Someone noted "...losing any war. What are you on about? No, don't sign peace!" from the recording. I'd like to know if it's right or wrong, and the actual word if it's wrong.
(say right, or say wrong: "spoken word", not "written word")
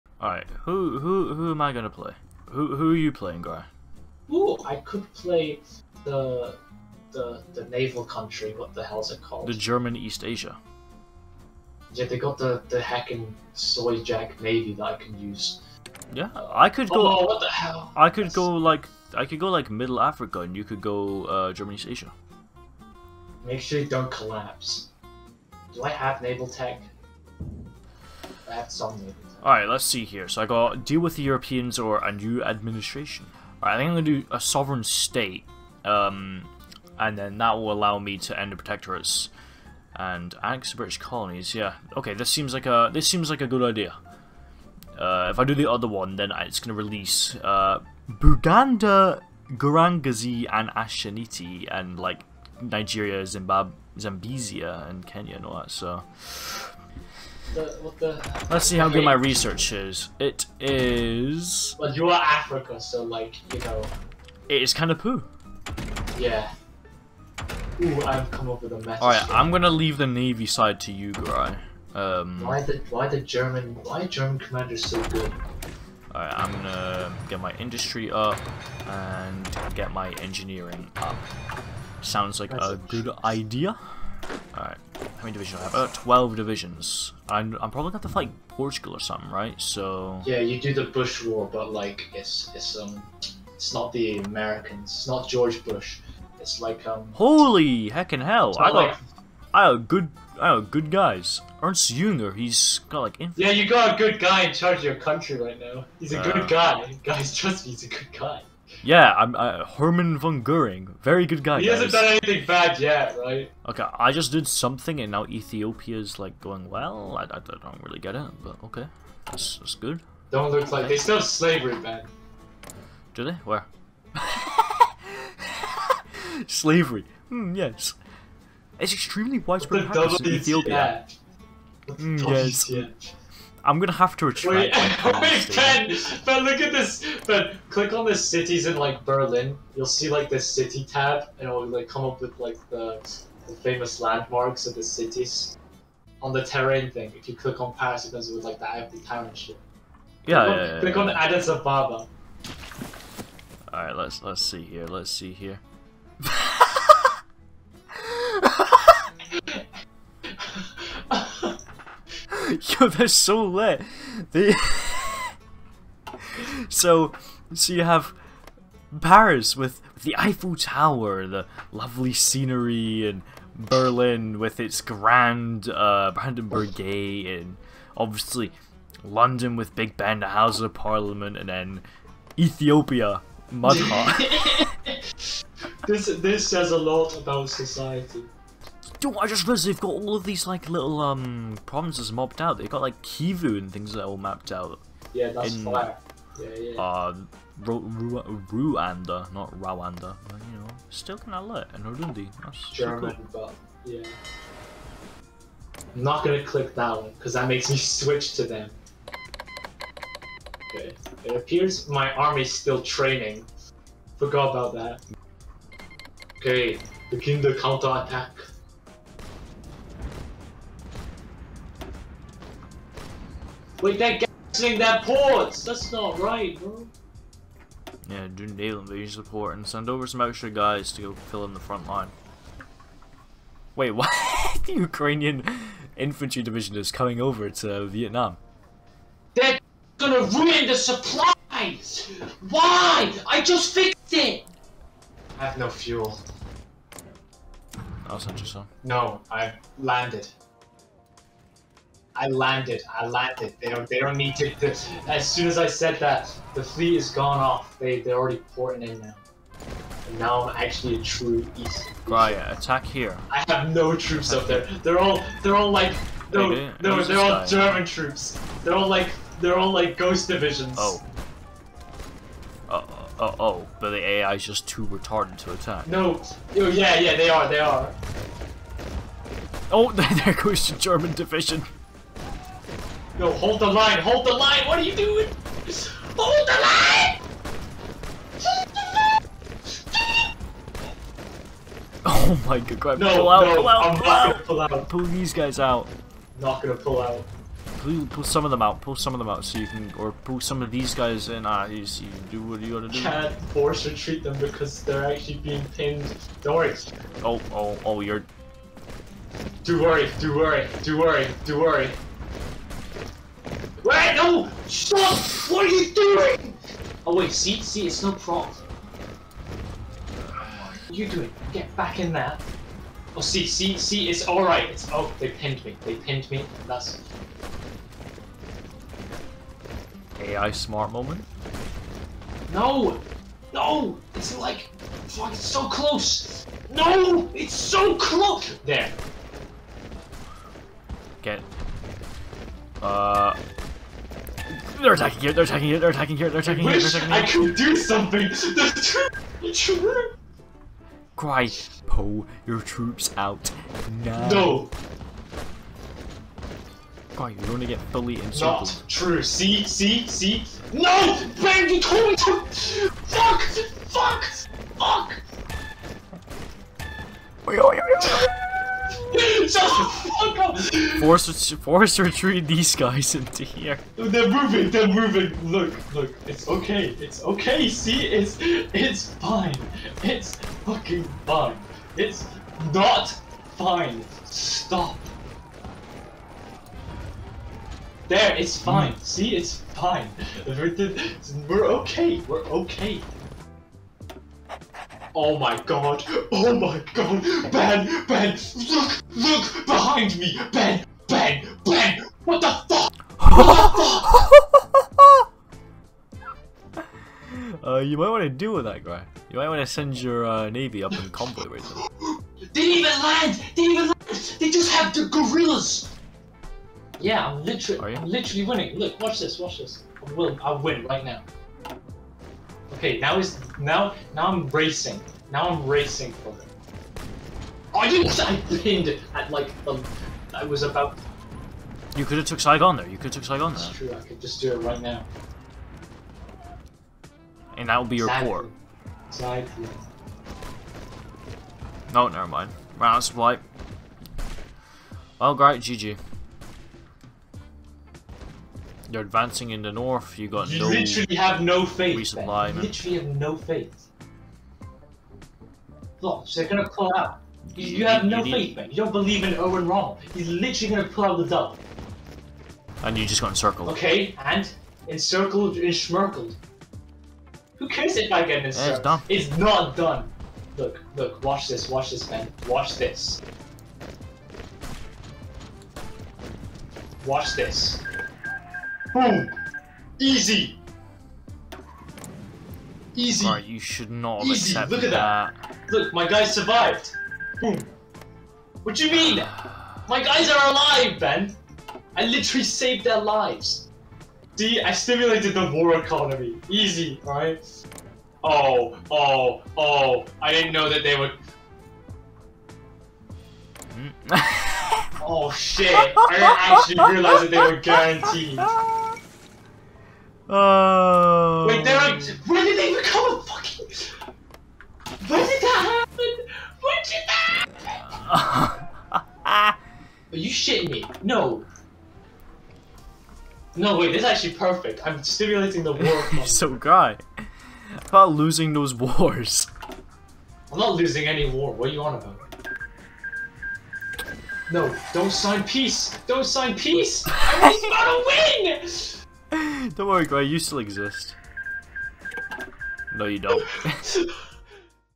right.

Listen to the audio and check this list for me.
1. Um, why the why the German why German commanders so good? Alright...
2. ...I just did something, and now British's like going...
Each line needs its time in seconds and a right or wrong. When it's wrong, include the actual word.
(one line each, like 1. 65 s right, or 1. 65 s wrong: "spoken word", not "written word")
1. 71 s right
2. 113 s wrong: "Ethiopia", not "British".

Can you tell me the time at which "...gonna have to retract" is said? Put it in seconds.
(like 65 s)
133 s.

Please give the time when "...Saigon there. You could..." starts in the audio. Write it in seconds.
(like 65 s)
432 s.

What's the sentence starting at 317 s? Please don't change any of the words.
Oh wait, see, see, it's no prop.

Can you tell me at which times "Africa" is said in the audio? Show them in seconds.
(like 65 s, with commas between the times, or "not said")
19 s, 62 s.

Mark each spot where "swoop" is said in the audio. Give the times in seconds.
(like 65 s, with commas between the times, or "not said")
not said.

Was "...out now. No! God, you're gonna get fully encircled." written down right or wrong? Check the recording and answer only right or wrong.
right.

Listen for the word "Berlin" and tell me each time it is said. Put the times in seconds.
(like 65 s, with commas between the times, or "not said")
139 s, 173 s.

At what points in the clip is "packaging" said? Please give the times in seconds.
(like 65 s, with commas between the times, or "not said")
not said.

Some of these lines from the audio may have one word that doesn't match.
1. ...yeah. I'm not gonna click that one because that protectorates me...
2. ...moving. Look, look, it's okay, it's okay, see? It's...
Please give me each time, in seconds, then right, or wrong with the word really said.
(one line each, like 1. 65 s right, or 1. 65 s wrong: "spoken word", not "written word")
1. 203 s wrong: "makes", not "protectorates"
2. 374 s right.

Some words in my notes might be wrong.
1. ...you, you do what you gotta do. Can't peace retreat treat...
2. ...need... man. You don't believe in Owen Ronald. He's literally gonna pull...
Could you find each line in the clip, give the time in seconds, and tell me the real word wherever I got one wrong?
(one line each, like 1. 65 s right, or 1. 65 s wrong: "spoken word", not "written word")
1. 301 s wrong: "force", not "peace"
2. 458 s right.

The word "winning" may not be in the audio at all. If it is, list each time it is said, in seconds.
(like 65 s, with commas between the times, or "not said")
418 s.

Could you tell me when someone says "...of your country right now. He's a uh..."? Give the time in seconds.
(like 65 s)
104 s.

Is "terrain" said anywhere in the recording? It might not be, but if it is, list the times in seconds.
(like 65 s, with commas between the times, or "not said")
146 s.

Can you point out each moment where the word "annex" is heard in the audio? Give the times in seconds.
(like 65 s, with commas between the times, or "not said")
40 s.